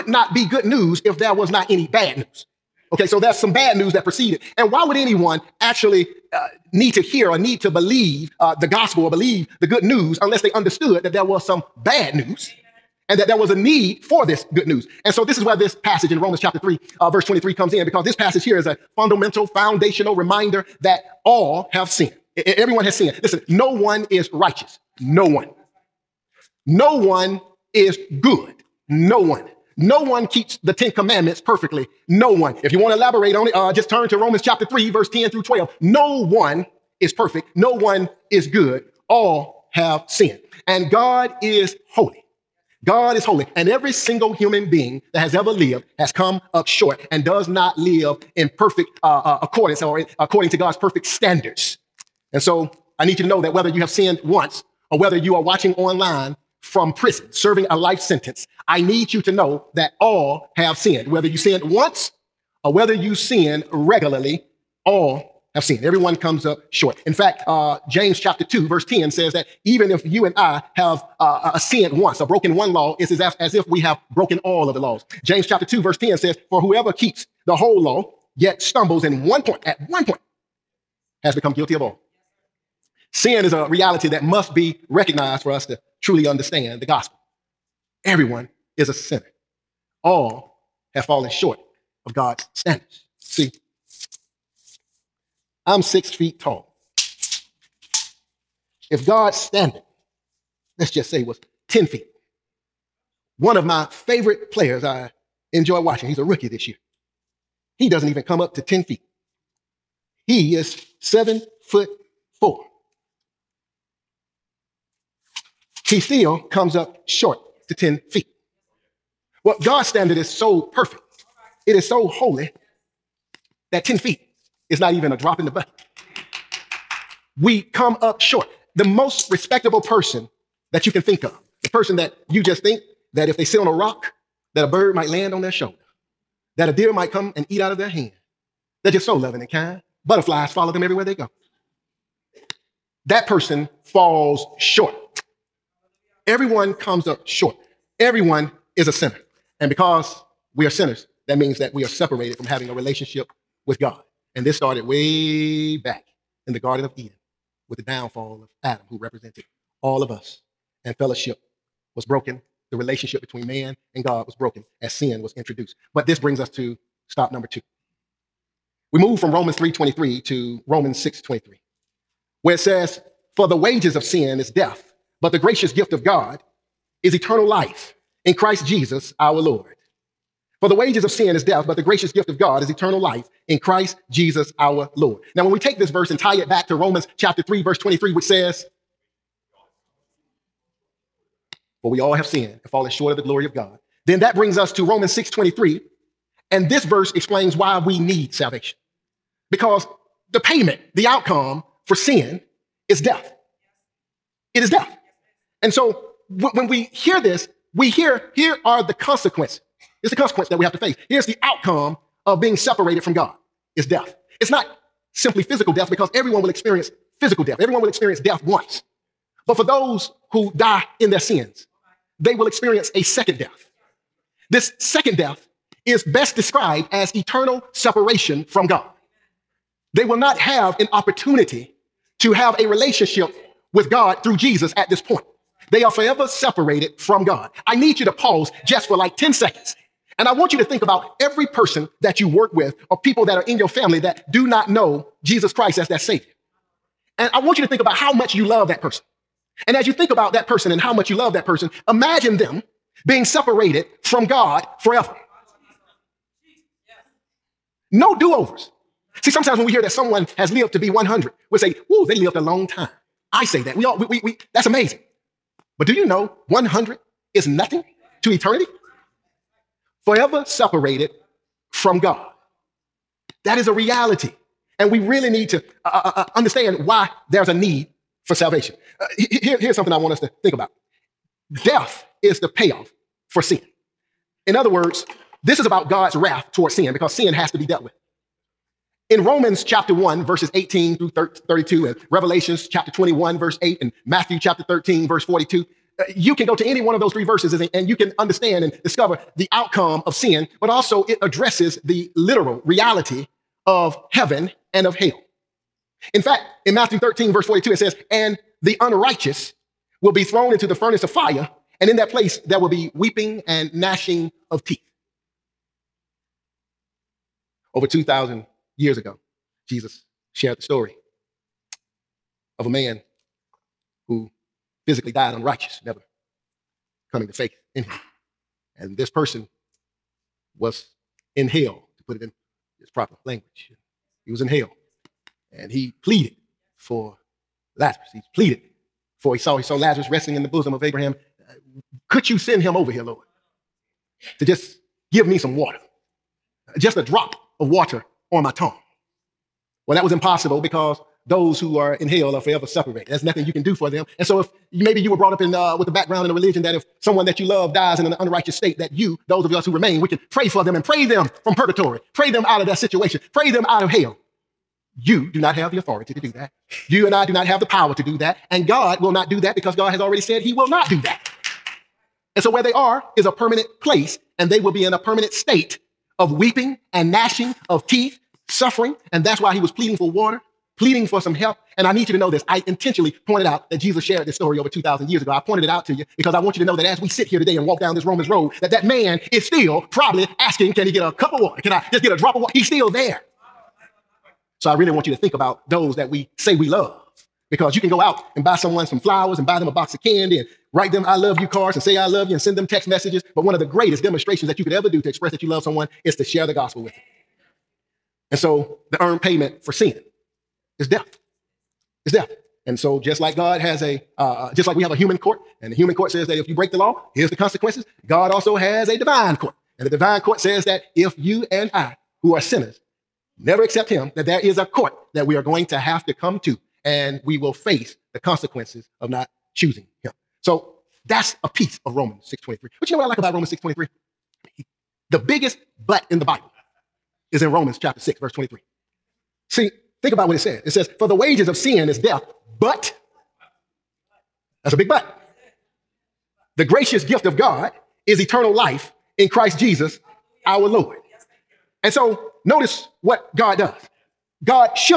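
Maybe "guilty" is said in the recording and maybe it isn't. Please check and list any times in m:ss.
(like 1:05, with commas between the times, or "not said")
1:21.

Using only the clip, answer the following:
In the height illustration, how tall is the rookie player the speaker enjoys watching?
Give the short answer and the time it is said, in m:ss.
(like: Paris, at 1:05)
7 foot 4, at 1:51.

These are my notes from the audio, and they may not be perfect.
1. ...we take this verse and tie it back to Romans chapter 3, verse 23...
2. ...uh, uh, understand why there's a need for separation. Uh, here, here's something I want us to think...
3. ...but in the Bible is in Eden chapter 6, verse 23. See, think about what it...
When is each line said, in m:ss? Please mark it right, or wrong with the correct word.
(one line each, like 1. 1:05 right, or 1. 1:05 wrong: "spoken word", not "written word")
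1. 3:05 right
2. 4:36 wrong: "salvation", not "separation"
3. 7:15 wrong: "Romans", not "Eden".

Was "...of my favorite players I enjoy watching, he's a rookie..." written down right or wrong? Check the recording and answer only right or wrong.
right.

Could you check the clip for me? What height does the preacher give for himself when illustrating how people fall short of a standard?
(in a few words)
6 feet.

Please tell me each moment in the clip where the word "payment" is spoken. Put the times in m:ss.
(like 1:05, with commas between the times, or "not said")
3:20, 6:49.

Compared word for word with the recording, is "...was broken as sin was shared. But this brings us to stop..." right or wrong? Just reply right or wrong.
wrong.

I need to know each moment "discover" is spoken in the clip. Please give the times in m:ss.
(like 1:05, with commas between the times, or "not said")
4:58.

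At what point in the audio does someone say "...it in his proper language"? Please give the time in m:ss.
5:32.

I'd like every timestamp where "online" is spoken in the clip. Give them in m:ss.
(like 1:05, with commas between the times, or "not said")
0:55.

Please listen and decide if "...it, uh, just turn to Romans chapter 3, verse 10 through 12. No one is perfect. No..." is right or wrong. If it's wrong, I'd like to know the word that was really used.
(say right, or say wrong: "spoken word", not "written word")
right.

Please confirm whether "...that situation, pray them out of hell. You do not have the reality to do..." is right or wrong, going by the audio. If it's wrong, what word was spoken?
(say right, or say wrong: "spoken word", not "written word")
wrong: "authority", not "reality".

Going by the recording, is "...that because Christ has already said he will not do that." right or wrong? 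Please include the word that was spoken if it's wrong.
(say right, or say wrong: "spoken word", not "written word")
wrong: "God", not "Christ".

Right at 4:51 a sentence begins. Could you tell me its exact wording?
32 and Revelations chapter 21, verse 8, and Matthew chapter 13, verse 42.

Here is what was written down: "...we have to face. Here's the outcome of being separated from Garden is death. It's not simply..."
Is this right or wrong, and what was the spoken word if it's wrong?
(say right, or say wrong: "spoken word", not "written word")
wrong: "God", not "Garden".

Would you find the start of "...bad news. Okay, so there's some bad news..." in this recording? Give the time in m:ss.
0:01.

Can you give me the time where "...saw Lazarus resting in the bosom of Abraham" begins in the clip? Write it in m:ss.
5:39.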